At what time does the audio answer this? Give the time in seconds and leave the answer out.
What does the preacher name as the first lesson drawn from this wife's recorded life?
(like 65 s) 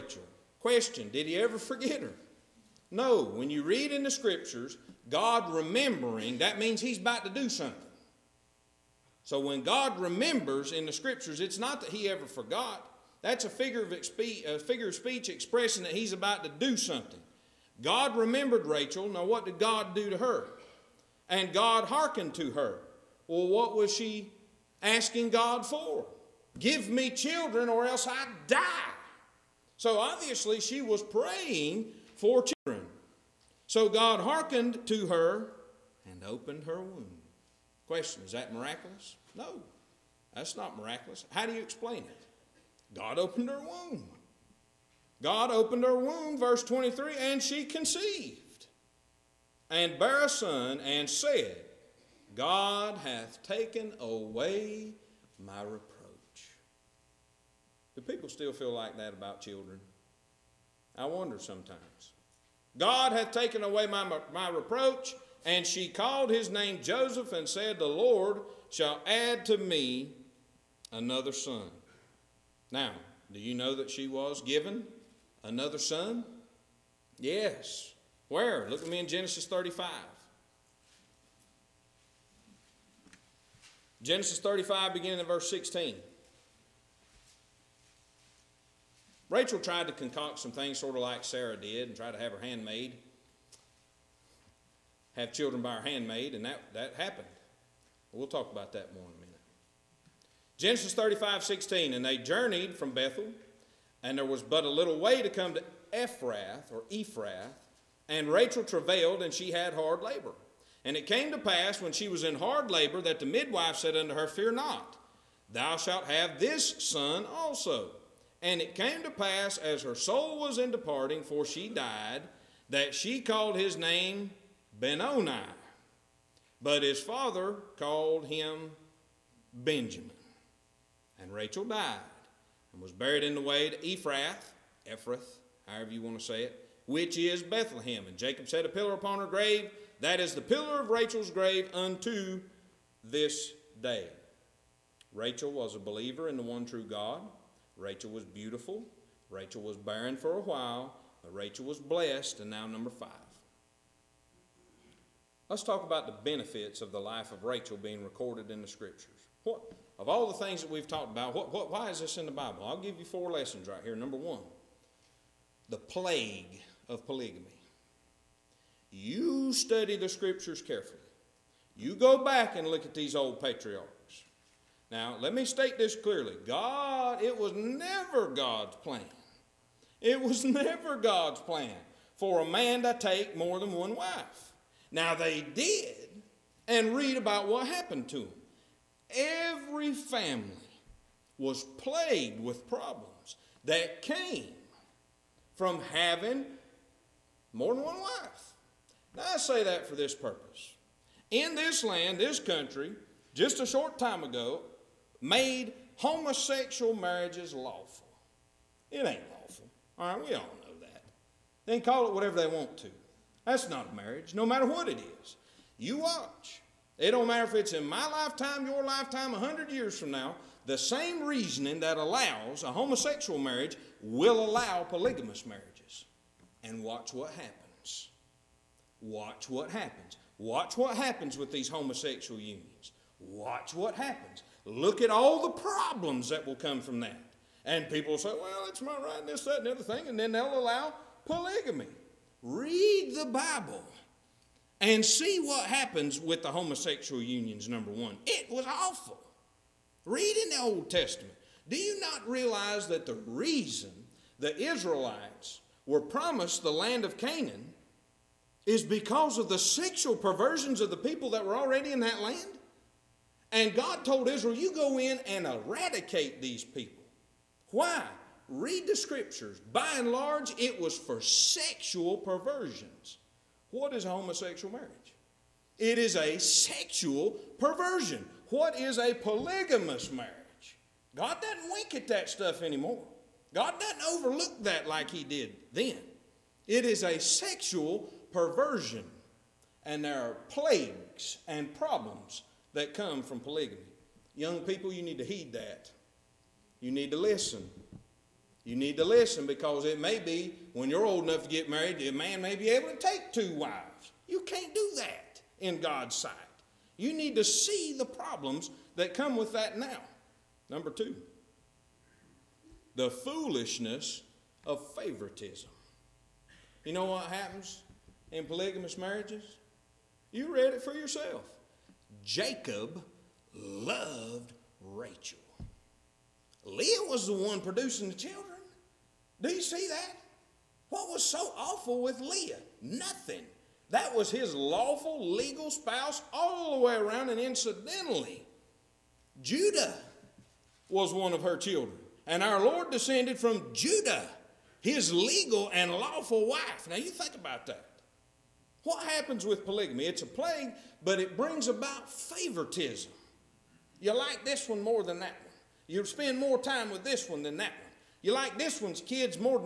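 165 s.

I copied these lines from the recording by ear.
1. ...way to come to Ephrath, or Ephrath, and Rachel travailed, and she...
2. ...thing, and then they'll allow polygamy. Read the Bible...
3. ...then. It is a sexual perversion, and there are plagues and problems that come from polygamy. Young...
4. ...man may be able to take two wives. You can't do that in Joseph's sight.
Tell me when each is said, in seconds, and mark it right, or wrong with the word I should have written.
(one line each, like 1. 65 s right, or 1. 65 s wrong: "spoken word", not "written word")
1. 104 s right
2. 239 s right
3. 285 s right
4. 302 s wrong: "God", not "Joseph".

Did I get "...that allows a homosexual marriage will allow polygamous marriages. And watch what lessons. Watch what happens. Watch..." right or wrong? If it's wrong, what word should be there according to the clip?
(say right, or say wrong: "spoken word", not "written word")
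wrong: "happens", not "lessons".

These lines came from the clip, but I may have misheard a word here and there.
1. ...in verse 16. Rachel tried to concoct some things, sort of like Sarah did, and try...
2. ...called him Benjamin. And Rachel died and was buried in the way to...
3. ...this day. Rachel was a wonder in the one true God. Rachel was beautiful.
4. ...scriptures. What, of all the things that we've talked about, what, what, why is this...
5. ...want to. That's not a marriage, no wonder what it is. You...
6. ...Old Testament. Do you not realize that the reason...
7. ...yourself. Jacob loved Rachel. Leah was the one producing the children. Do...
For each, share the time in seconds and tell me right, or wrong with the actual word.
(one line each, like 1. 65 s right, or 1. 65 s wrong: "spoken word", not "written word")
1. 85 s right
2. 127 s right
3. 143 s wrong: "believer", not "wonder"
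4. 158 s right
5. 212 s wrong: "matter", not "wonder"
6. 250 s right
7. 320 s right.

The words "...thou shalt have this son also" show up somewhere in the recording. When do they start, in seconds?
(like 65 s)
115 s.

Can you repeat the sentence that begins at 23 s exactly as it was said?
Well, what was she asking God for?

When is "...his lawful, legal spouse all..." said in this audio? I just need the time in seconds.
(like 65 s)
334 s.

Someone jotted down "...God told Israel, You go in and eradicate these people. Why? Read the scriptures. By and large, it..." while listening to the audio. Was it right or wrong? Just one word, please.
right.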